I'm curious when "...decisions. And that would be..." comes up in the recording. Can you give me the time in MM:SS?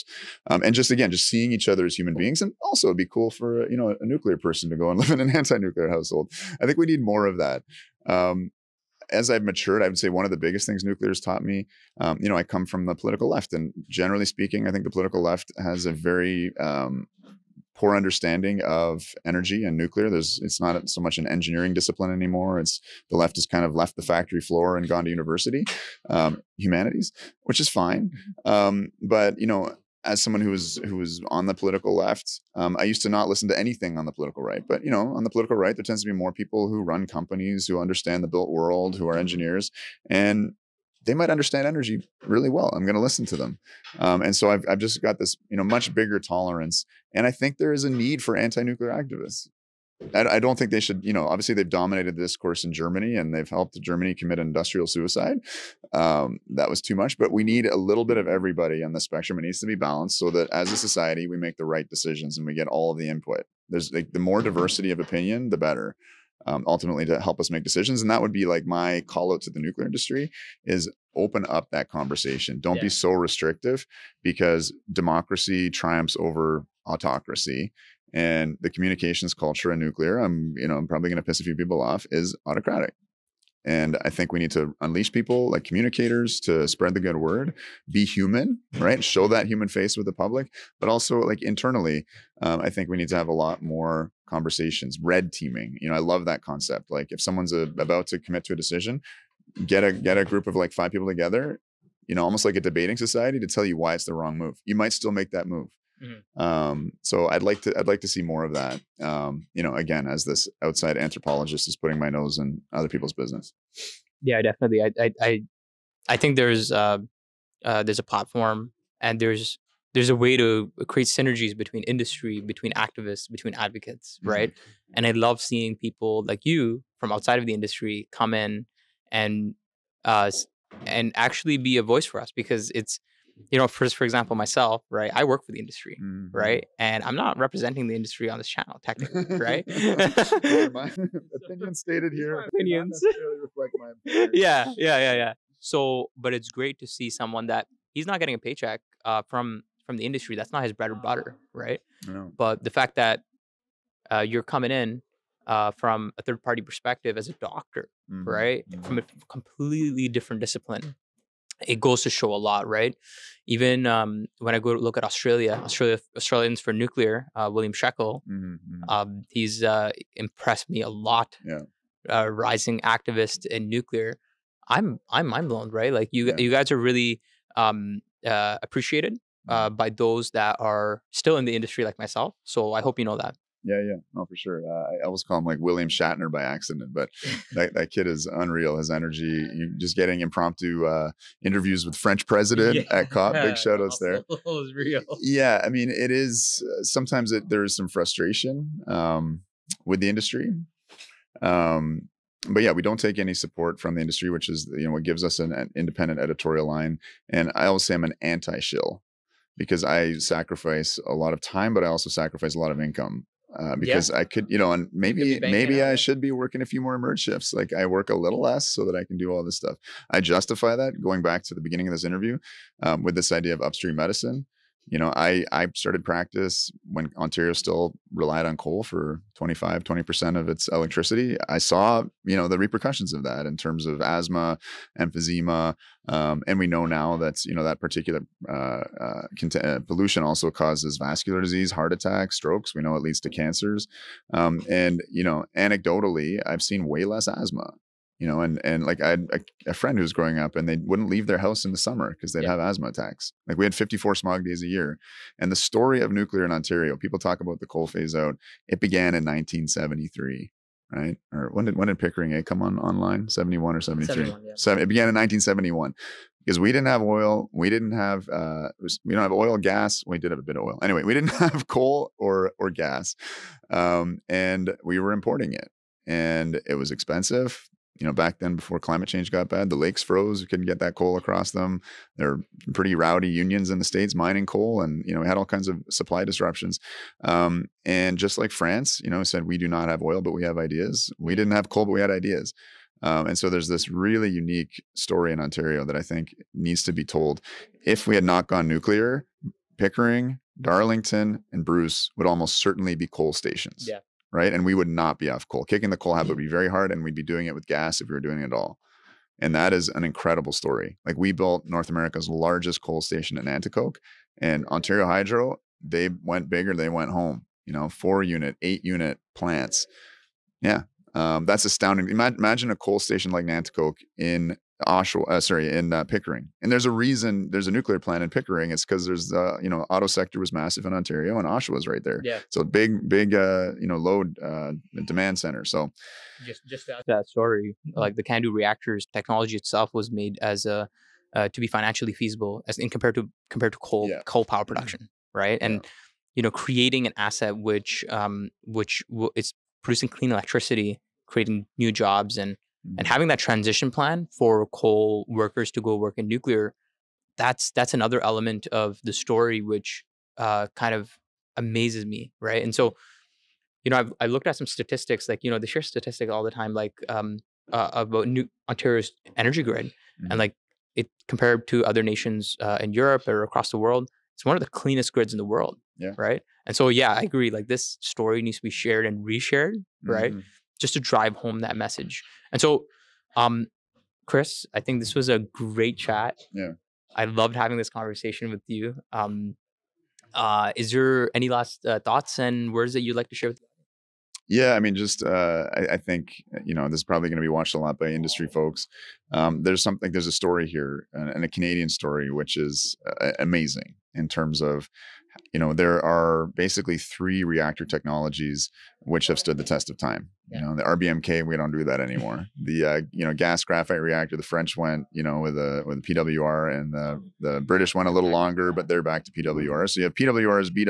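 01:07.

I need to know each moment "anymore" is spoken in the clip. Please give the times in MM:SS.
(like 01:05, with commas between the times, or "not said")
00:22, 06:52.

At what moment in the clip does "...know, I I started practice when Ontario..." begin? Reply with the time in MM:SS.
03:44.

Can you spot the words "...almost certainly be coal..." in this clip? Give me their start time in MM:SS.
05:02.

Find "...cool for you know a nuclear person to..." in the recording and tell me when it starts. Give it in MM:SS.
00:03.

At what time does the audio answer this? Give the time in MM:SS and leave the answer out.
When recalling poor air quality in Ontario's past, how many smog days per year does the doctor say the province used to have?
04:13.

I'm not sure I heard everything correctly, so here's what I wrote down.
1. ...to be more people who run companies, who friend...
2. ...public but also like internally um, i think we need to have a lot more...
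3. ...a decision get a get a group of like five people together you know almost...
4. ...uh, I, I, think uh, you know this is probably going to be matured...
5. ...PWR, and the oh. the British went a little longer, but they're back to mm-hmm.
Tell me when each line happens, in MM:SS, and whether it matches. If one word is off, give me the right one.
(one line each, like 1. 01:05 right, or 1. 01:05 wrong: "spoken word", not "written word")
1. 00:36 wrong: "understand", not "friend"
2. 01:30 right
3. 01:38 right
4. 06:35 wrong: "watched", not "matured"
5. 06:56 right.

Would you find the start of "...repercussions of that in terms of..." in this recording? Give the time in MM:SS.
03:52.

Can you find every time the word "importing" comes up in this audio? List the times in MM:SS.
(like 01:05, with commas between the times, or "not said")
04:35.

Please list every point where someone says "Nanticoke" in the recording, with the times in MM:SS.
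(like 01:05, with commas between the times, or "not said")
05:13, 05:23.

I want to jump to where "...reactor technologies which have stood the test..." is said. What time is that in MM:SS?
06:47.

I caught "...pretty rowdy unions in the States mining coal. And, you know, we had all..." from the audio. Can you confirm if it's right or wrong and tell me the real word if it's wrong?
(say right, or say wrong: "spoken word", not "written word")
right.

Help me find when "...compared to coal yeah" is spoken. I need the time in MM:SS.
05:43.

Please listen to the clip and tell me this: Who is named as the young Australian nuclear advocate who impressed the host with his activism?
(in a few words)
William Shackel.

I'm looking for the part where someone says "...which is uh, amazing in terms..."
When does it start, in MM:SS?
06:42.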